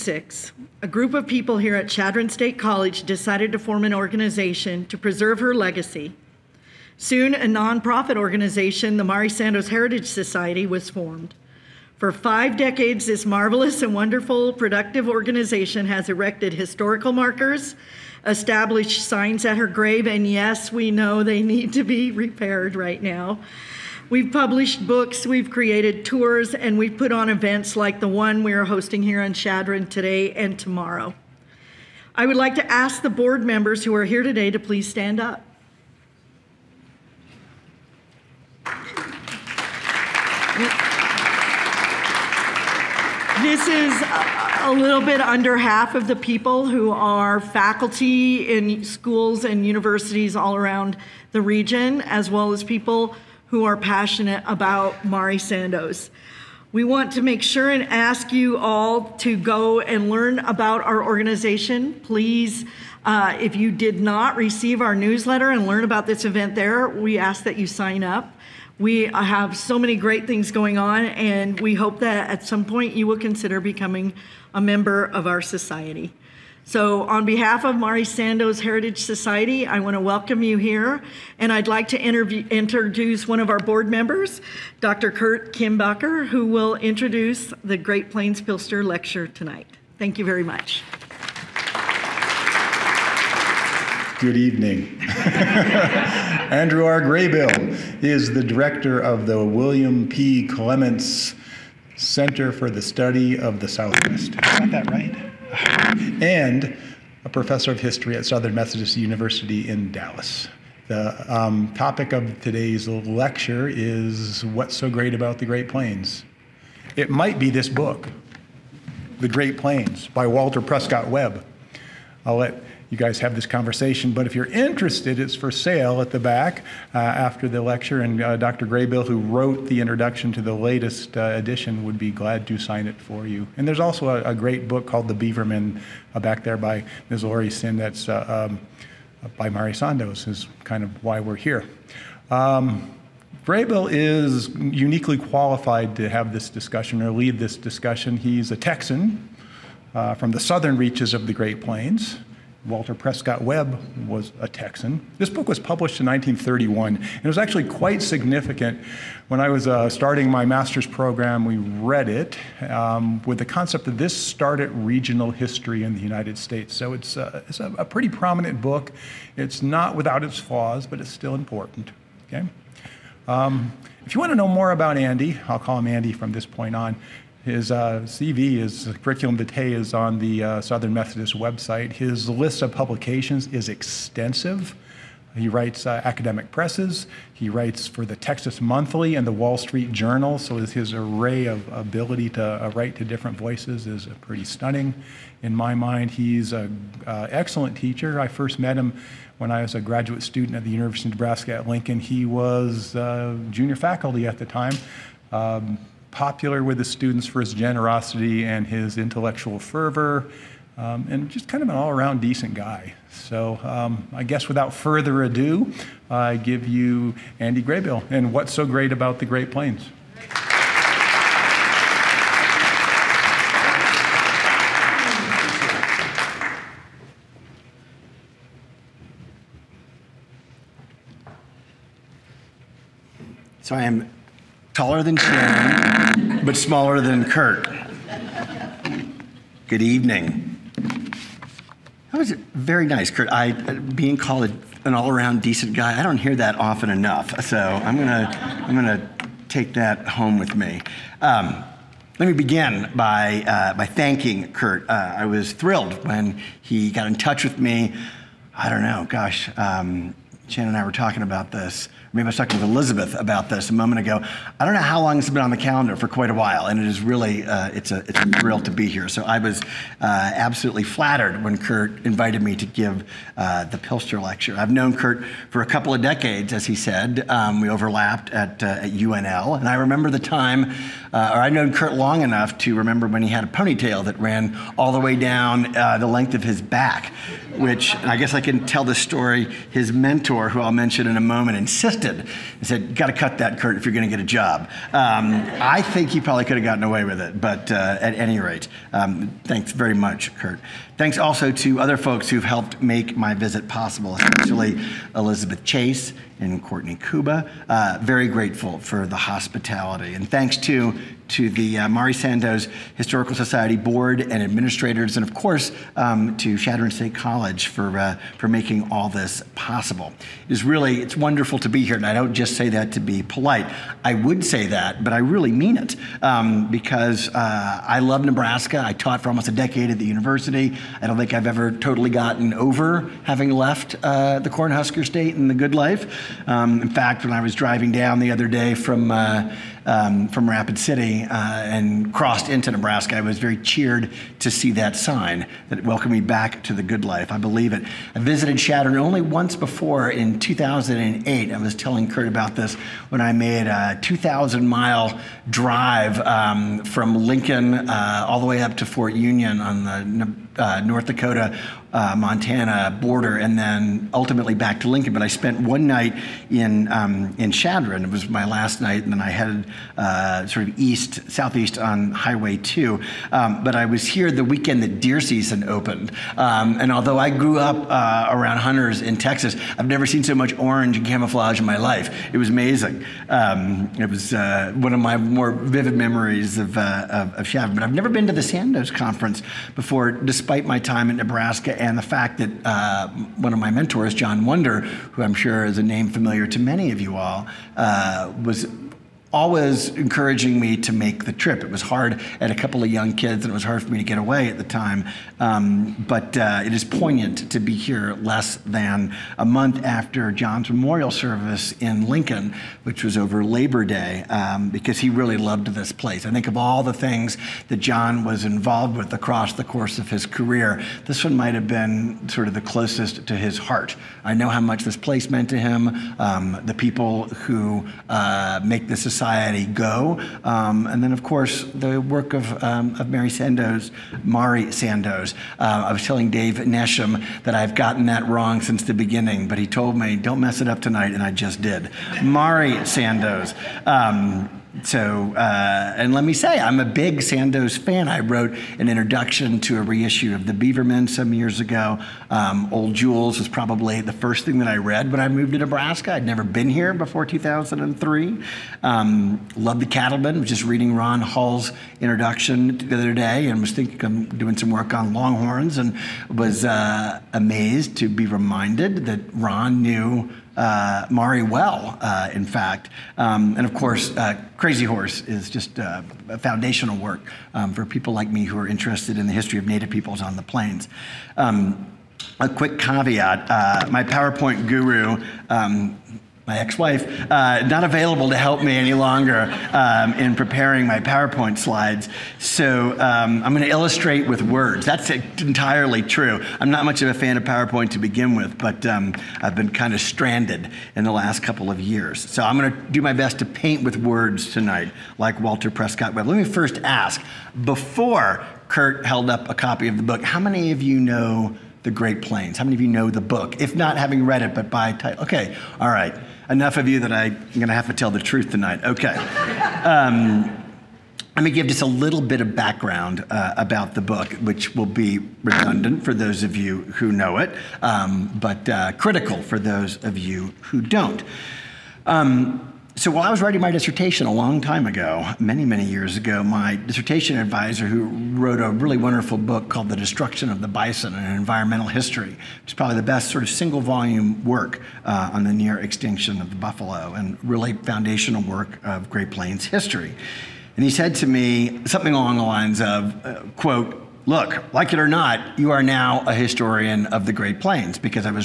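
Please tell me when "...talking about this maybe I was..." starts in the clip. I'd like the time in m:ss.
4:20.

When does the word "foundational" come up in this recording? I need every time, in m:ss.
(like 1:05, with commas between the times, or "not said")
7:56, 9:07.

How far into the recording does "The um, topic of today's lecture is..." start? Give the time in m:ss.
1:50.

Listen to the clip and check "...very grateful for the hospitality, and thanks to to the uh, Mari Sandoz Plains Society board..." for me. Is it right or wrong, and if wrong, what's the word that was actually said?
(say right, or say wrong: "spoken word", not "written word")
wrong: "Historical", not "Plains".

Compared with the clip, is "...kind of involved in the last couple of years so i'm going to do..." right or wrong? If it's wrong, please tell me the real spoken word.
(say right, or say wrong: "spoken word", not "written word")
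wrong: "stranded", not "involved".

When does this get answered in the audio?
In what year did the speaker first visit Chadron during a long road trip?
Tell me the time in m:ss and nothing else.
5:50.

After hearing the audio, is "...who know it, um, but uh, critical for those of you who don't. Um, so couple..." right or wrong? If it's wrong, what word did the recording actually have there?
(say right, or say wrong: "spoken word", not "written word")
wrong: "while", not "couple".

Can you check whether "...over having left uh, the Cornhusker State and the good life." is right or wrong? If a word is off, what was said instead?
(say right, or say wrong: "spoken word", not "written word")
right.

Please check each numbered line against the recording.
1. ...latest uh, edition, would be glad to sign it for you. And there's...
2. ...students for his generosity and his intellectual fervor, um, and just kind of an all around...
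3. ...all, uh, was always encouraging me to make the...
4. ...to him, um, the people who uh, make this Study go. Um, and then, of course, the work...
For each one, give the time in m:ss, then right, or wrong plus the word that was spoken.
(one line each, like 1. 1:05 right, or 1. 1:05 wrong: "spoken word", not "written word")
1. 2:10 right
2. 3:26 right
3. 6:37 right
4. 7:05 wrong: "Society", not "Study".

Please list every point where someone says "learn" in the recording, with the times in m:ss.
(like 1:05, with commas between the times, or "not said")
1:00, 1:05.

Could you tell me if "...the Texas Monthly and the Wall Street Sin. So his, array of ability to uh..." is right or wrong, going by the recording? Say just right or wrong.
wrong.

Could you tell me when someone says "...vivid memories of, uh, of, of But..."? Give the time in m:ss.
6:25.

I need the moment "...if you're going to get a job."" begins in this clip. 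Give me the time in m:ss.
4:53.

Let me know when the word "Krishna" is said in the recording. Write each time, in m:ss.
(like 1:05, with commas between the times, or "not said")
not said.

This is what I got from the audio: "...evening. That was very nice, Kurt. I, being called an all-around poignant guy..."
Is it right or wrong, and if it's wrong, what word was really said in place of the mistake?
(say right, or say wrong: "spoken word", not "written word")
wrong: "decent", not "poignant".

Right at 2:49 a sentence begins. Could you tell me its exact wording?
It's not without its flaws, but it's still important.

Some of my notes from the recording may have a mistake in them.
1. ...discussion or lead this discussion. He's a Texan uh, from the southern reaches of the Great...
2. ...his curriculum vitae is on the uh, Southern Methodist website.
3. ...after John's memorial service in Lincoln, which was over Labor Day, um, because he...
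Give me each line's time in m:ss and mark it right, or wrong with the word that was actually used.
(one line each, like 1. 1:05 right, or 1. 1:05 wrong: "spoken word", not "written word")
1. 2:26 right
2. 2:58 right
3. 6:49 right.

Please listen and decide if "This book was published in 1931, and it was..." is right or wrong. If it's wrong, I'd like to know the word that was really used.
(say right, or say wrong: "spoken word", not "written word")
right.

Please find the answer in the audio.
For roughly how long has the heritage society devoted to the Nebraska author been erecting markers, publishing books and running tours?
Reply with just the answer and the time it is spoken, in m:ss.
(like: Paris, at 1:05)
Five decades, at 0:12.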